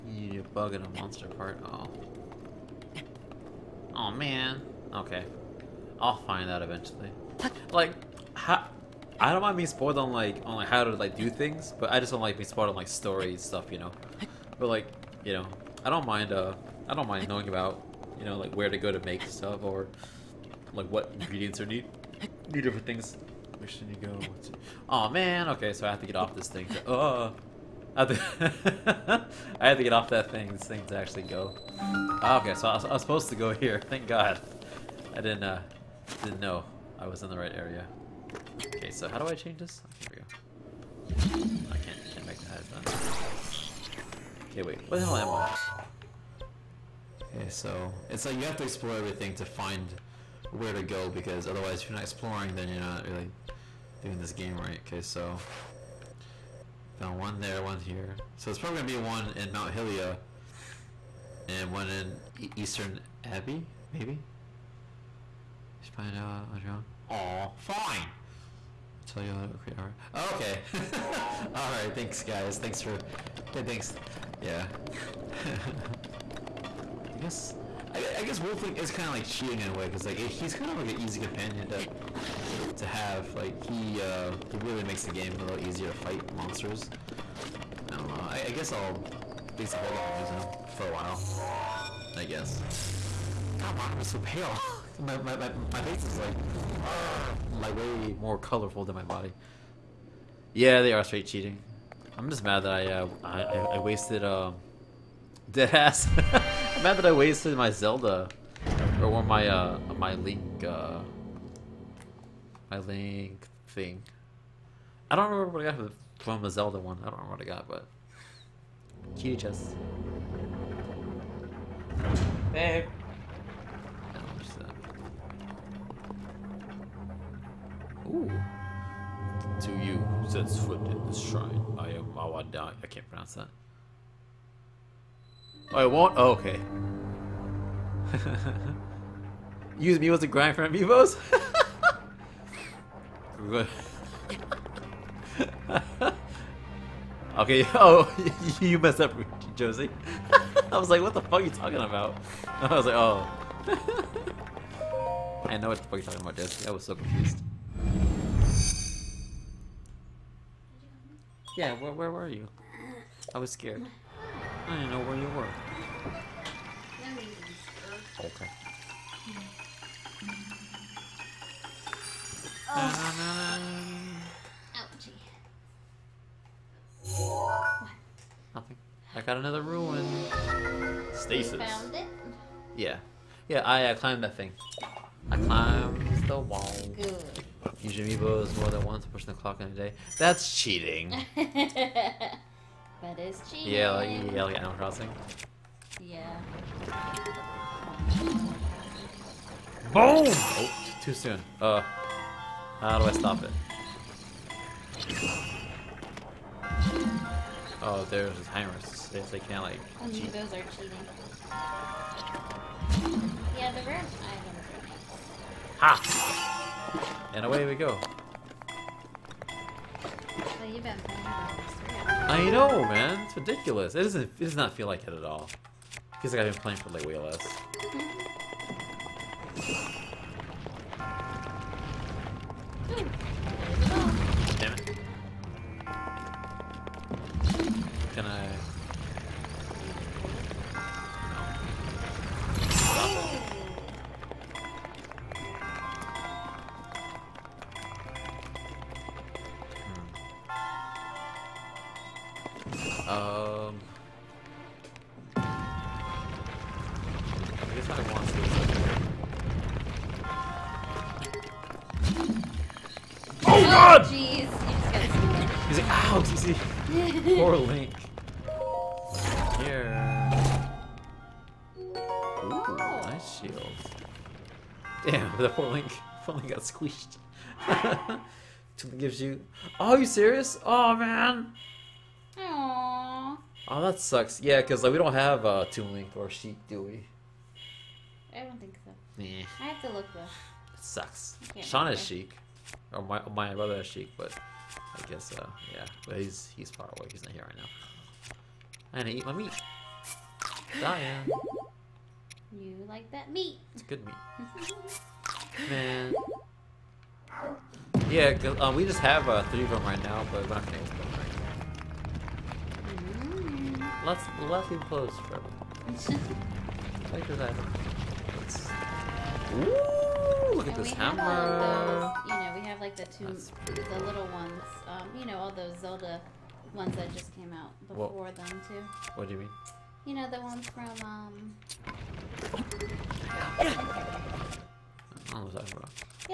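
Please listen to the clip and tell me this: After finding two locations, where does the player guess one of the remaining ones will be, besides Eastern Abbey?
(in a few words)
Mount Hylia.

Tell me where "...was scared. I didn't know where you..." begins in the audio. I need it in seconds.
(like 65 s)
163 s.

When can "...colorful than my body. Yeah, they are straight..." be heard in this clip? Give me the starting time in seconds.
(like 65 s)
98 s.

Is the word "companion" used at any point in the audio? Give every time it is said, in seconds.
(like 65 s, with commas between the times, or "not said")
81 s.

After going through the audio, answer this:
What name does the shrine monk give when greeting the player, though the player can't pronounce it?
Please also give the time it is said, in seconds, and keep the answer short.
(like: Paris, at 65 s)
Owa Daim, at 132 s.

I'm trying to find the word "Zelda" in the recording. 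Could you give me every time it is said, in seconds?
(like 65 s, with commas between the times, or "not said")
107 s, 116 s, 325 s.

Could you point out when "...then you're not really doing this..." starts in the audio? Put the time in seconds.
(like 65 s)
52 s.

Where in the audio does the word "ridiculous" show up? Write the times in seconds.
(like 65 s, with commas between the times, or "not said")
223 s.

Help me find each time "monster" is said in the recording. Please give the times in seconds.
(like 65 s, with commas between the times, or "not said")
0 s, 86 s.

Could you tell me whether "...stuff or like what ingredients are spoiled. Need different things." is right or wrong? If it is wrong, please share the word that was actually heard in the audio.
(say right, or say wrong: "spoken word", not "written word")
wrong: "needed", not "spoiled".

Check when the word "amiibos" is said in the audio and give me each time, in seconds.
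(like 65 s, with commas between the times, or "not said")
140 s, 187 s.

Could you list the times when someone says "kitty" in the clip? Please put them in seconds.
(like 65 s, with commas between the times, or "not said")
119 s.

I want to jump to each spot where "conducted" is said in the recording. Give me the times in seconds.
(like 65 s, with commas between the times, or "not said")
not said.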